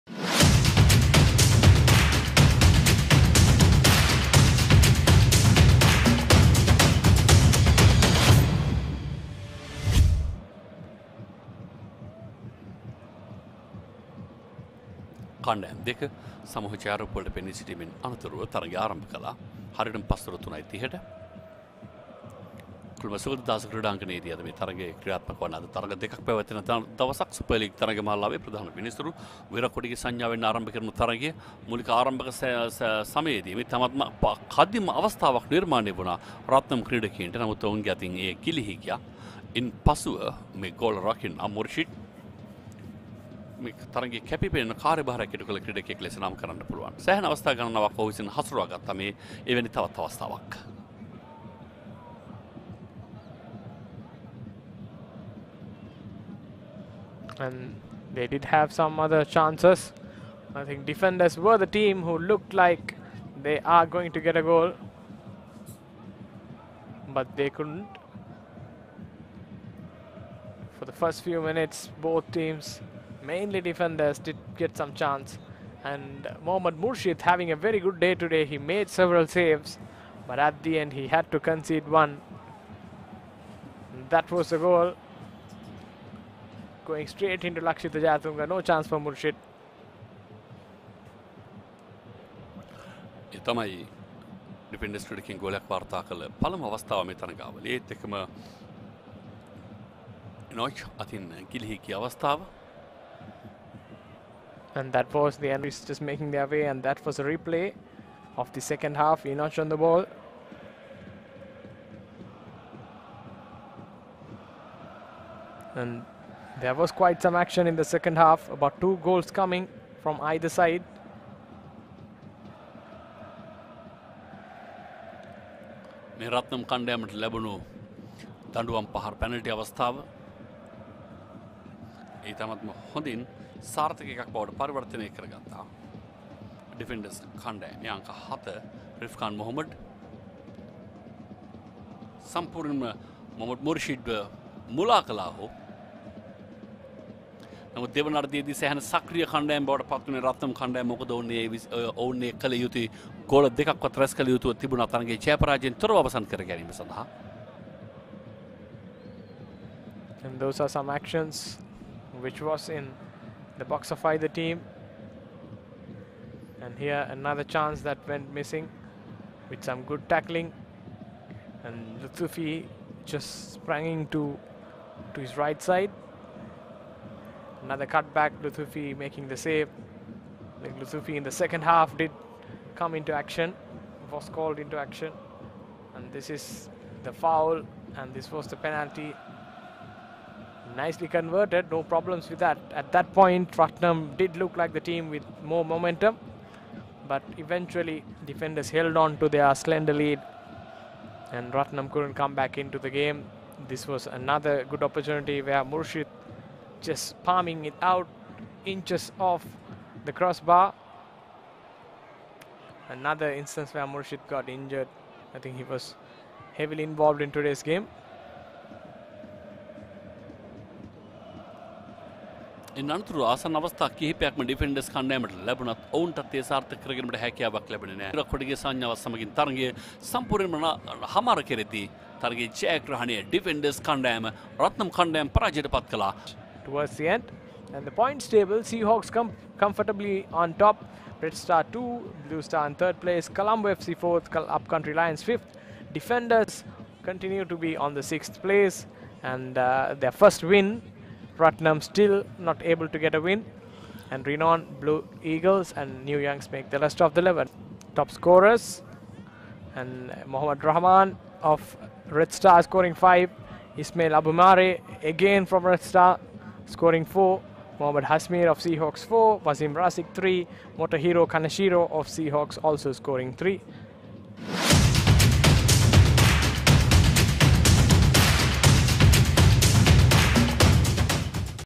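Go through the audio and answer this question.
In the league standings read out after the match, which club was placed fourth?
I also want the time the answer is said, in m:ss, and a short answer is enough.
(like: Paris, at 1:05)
Colombo FC, at 4:03.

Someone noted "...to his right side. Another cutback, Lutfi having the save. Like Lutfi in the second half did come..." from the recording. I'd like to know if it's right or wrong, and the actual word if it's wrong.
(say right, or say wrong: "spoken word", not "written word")
wrong: "making", not "having".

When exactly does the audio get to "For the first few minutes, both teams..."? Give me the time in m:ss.
1:10.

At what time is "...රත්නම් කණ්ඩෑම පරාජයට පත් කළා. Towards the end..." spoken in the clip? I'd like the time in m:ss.
3:54.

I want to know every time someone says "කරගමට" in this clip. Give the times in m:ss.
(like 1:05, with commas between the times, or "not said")
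3:46.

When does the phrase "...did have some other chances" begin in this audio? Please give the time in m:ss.
0:58.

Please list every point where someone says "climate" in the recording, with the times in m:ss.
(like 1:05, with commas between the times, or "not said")
not said.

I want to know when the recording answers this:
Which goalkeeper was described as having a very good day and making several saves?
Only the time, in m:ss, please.
1:16.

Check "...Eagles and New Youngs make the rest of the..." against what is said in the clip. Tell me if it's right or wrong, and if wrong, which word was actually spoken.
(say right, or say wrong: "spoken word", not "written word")
right.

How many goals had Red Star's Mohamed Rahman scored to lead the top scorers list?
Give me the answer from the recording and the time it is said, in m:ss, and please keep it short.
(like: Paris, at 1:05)
5, at 4:22.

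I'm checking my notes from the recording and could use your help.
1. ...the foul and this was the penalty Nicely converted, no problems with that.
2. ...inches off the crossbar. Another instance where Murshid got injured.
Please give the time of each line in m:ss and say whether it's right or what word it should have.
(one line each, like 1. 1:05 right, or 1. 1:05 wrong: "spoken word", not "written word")
1. 3:07 right
2. 3:28 right.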